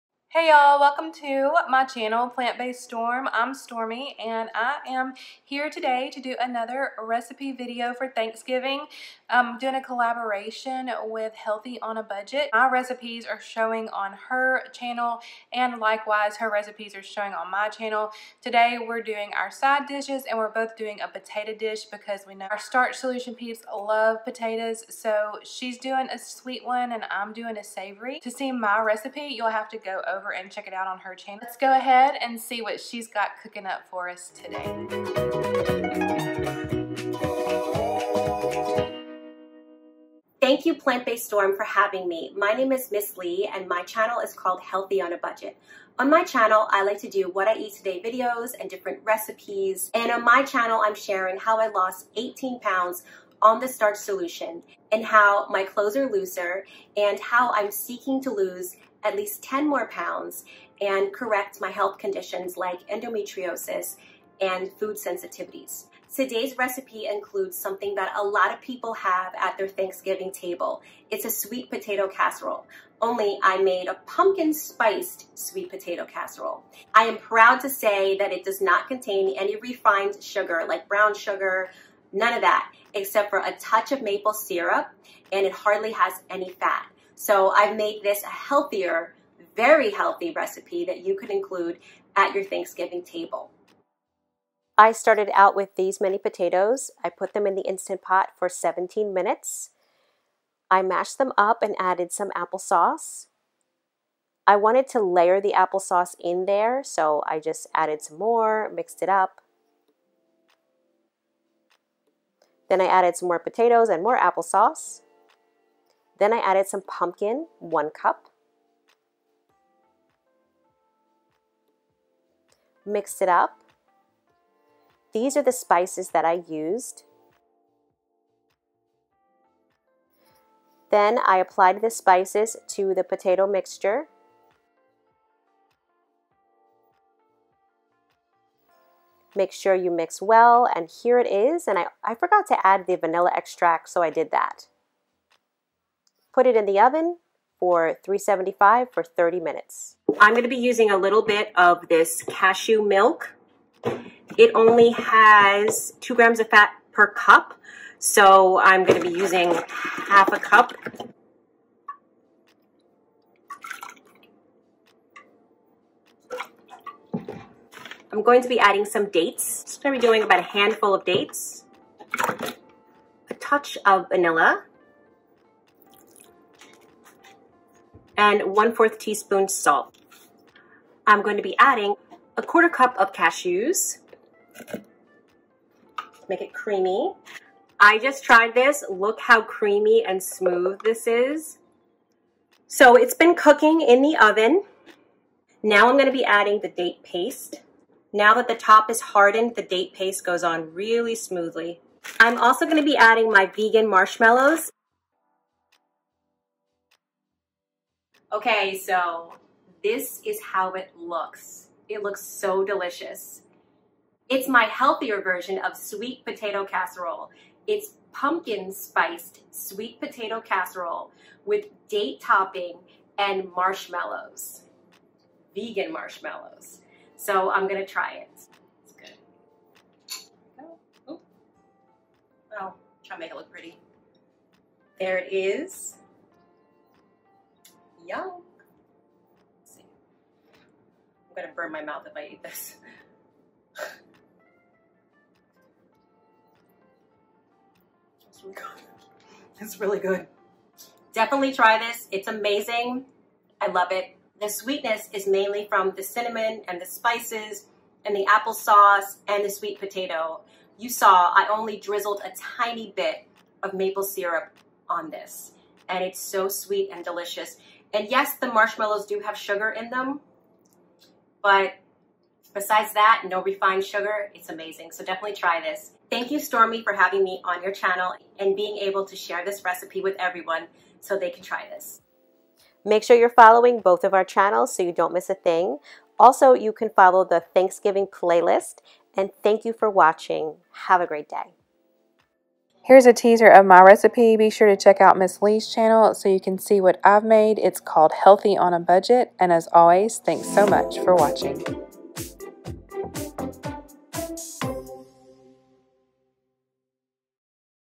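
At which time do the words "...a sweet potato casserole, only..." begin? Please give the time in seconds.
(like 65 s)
71 s.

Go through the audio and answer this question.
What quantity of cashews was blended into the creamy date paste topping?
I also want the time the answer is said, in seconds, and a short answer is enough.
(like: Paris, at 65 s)
a quarter cup, at 182 s.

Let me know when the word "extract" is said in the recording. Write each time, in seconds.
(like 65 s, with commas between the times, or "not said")
143 s.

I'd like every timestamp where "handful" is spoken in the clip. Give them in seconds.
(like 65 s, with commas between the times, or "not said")
170 s.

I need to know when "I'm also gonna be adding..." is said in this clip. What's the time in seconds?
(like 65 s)
202 s.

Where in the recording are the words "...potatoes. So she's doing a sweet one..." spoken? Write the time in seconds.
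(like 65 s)
24 s.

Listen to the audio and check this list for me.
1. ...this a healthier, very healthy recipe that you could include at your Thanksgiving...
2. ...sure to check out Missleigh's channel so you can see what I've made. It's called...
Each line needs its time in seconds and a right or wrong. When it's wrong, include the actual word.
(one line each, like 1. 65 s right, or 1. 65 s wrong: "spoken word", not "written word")
1. 88 s right
2. 294 s right.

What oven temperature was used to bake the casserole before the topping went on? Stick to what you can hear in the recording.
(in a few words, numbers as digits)
375.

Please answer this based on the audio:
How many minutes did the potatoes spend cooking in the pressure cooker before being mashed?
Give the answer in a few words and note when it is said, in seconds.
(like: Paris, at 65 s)
17, at 98 s.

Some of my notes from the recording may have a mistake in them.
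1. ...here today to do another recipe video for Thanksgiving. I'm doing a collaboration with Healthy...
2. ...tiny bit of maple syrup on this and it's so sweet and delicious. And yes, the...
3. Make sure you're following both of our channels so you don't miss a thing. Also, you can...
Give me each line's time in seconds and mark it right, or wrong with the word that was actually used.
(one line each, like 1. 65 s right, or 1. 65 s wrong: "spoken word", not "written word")
1. 5 s right
2. 262 s right
3. 282 s right.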